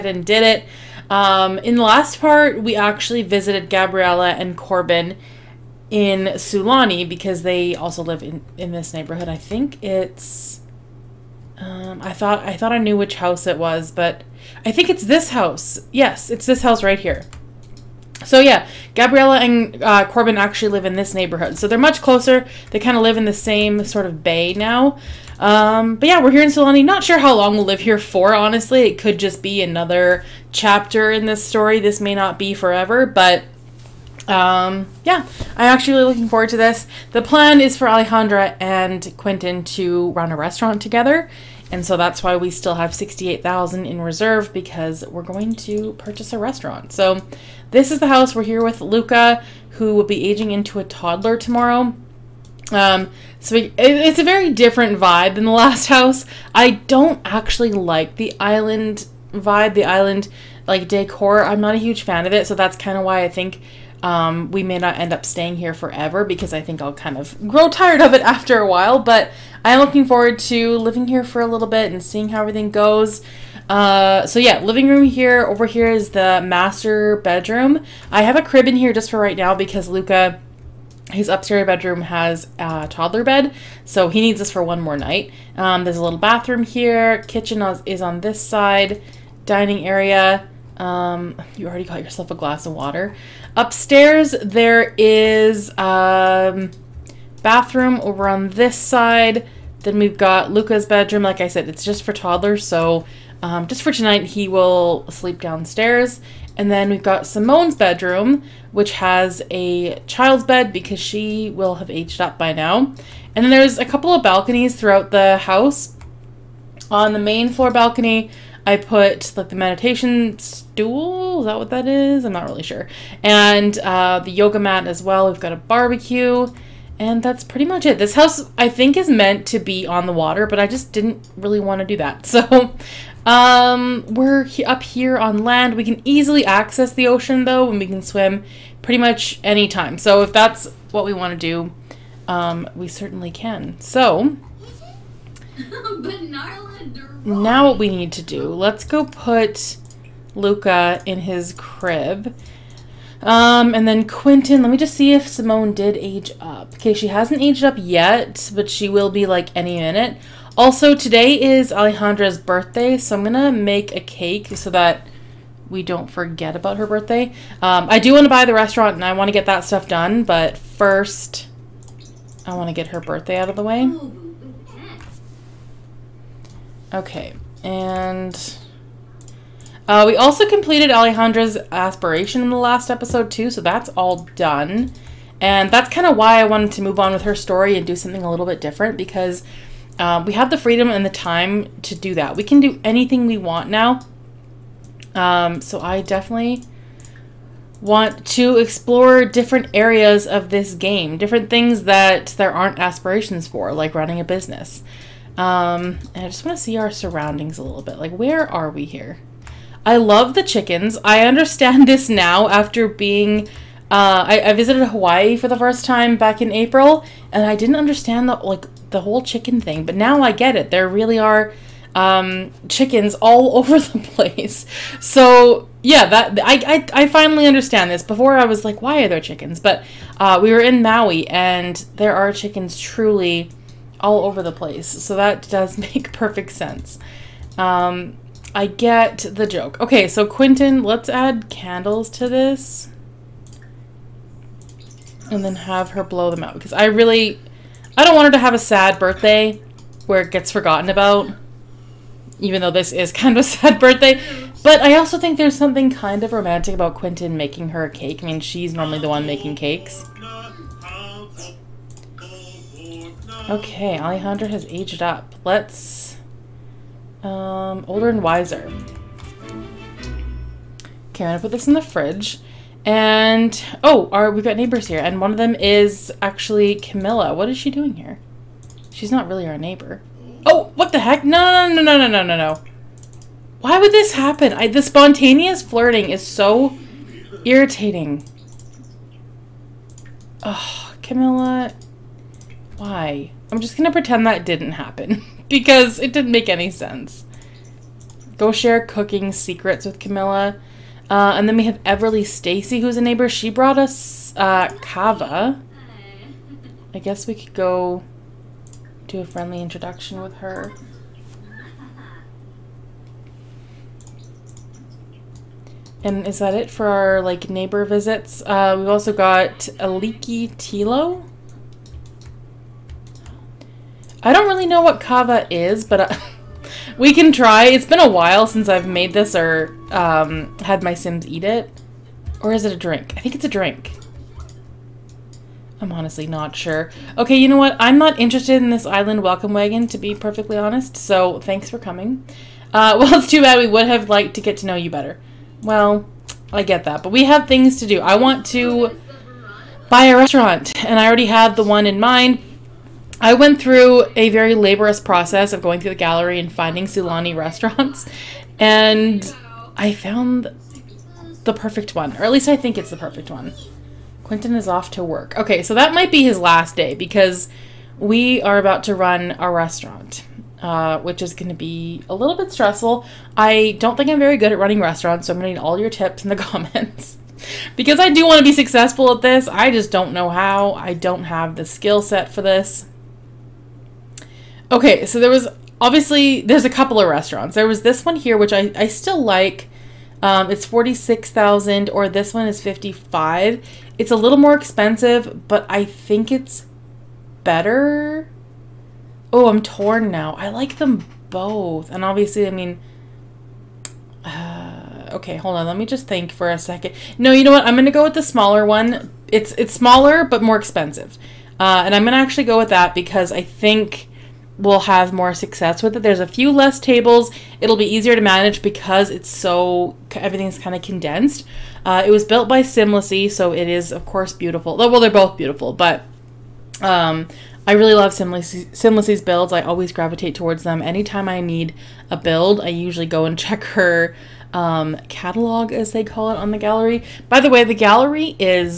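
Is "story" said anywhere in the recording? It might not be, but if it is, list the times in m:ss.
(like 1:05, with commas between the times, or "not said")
0:31, 3:07.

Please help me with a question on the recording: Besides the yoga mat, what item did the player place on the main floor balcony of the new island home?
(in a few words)
meditation stool.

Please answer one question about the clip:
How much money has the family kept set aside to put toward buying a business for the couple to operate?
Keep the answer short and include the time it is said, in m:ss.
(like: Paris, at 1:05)
68,000, at 0:42.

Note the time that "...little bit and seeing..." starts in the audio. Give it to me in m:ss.
1:11.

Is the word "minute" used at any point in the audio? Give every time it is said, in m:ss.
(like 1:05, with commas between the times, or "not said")
2:39.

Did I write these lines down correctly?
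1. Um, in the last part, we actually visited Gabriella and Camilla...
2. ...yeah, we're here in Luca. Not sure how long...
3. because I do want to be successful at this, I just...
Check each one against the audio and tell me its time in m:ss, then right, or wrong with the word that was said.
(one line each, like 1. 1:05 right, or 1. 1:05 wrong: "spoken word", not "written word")
1. 0:01 wrong: "Corbin", not "Camilla"
2. 0:26 wrong: "Sulani", not "Luca"
3. 6:17 right.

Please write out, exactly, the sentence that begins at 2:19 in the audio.
So if that's what we want to do, um, we certainly can.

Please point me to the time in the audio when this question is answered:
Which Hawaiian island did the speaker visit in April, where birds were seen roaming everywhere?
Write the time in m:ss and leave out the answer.
3:50.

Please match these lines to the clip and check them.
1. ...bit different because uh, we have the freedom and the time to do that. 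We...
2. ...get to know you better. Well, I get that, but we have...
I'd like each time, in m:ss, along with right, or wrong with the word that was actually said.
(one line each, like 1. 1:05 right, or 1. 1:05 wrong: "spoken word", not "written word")
1. 3:08 right
2. 5:44 right.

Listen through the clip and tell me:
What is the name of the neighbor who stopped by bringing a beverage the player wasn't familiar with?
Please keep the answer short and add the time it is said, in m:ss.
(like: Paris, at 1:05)
Everly Stacy, at 5:01.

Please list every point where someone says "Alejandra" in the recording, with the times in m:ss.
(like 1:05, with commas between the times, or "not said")
0:37, 2:41, 3:00, 4:23.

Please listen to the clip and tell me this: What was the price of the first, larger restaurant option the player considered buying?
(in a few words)
46,000.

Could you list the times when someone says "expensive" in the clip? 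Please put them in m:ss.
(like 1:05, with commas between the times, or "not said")
6:34, 6:50.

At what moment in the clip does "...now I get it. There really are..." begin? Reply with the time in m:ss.
3:39.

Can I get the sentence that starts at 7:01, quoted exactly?
Uh, it was built by Simlessy, so it is of course beautiful.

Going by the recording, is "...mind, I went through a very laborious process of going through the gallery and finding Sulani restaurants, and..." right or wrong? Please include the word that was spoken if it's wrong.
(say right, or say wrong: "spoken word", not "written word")
right.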